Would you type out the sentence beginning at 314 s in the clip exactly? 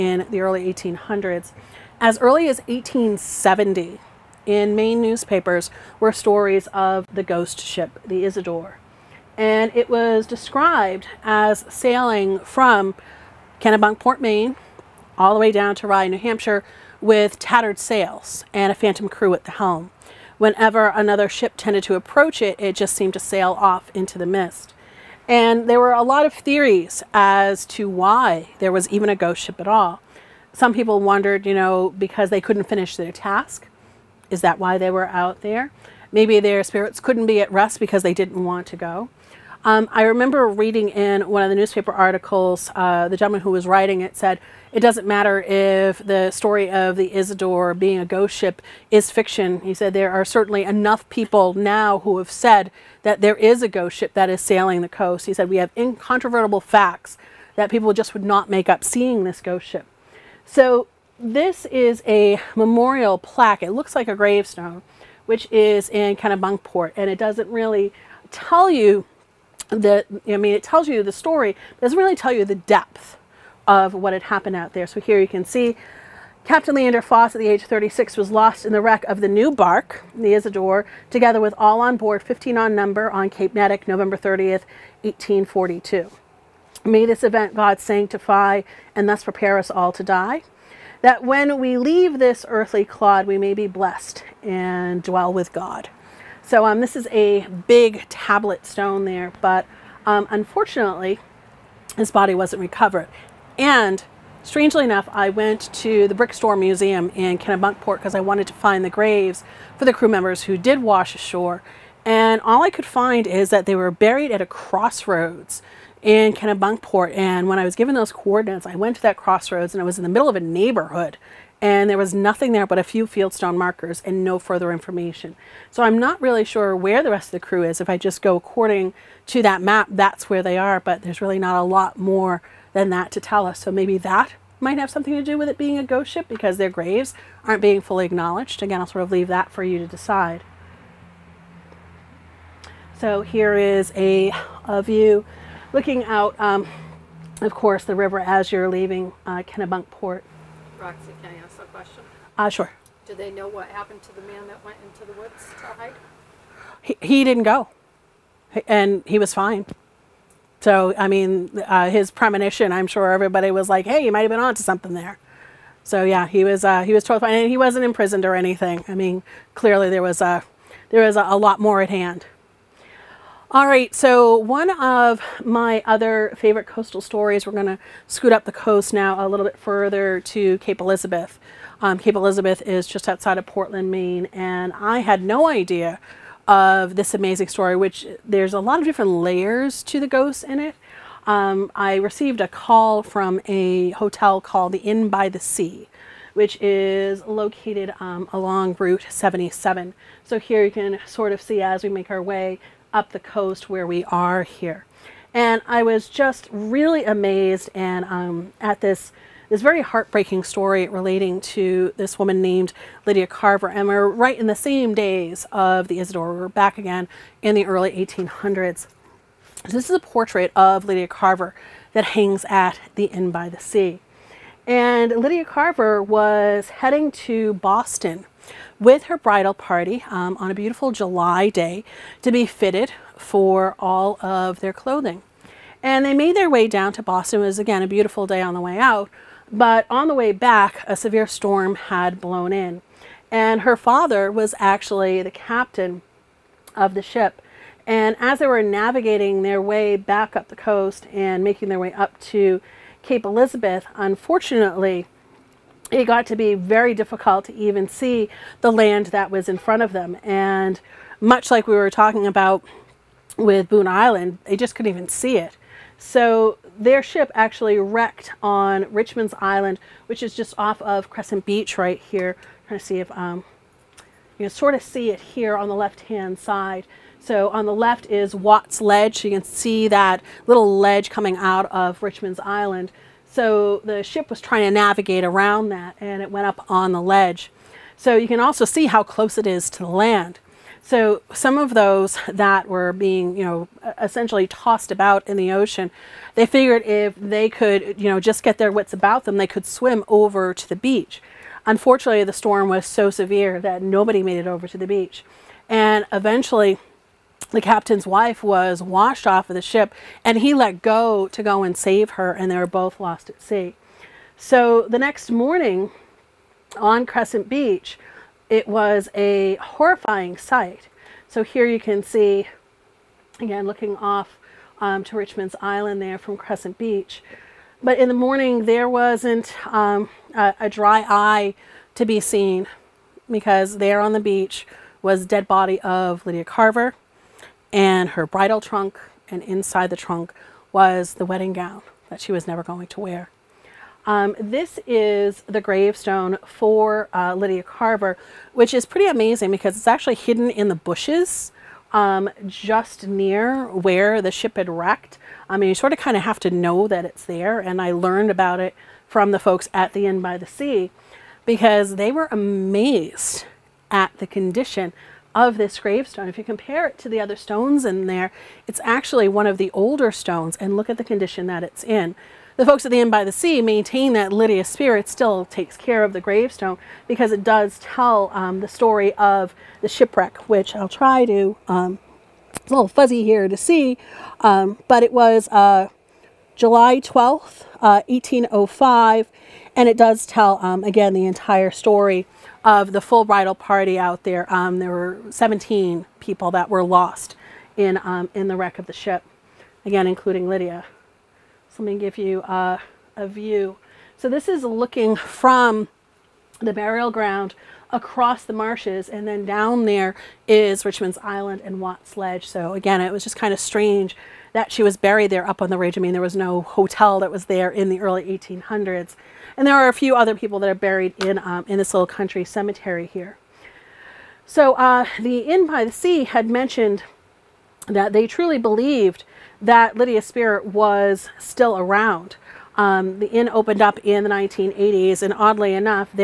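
So the next morning on Crescent Beach, it was a horrifying sight.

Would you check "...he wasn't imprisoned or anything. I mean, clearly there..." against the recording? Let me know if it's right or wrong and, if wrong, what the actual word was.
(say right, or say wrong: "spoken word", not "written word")
right.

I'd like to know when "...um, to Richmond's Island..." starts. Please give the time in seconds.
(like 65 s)
324 s.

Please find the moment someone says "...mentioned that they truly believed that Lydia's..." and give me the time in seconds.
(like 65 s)
426 s.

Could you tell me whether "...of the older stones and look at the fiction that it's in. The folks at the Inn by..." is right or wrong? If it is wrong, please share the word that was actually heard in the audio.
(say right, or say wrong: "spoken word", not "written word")
wrong: "condition", not "fiction".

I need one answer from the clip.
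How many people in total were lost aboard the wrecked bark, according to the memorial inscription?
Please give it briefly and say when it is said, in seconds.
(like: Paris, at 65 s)
15, at 82 s.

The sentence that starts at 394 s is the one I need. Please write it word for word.
Um, there were 17 people that were lost in, um, in the wreck of the ship, again, including Lydia.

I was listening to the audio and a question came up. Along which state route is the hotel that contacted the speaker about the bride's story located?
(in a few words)
Route 77.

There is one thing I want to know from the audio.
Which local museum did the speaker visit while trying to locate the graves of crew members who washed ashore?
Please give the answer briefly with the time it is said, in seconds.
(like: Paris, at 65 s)
Brick Store Museum, at 106 s.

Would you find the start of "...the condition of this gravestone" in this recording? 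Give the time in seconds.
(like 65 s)
364 s.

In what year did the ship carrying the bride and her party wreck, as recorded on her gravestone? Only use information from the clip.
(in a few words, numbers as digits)
1805.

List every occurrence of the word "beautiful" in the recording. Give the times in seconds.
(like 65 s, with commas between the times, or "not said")
230 s, 237 s.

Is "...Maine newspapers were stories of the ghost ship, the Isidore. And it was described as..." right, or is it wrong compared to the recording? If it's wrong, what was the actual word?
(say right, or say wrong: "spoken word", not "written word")
right.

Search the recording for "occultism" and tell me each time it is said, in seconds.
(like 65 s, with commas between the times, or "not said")
not said.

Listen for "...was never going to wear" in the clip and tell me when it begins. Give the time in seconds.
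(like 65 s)
342 s.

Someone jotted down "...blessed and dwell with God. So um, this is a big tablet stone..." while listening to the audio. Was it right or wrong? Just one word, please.
right.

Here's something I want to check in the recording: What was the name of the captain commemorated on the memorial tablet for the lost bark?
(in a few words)
Leander Foss.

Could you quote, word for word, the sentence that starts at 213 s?
And we're right in the same days of the Isidore.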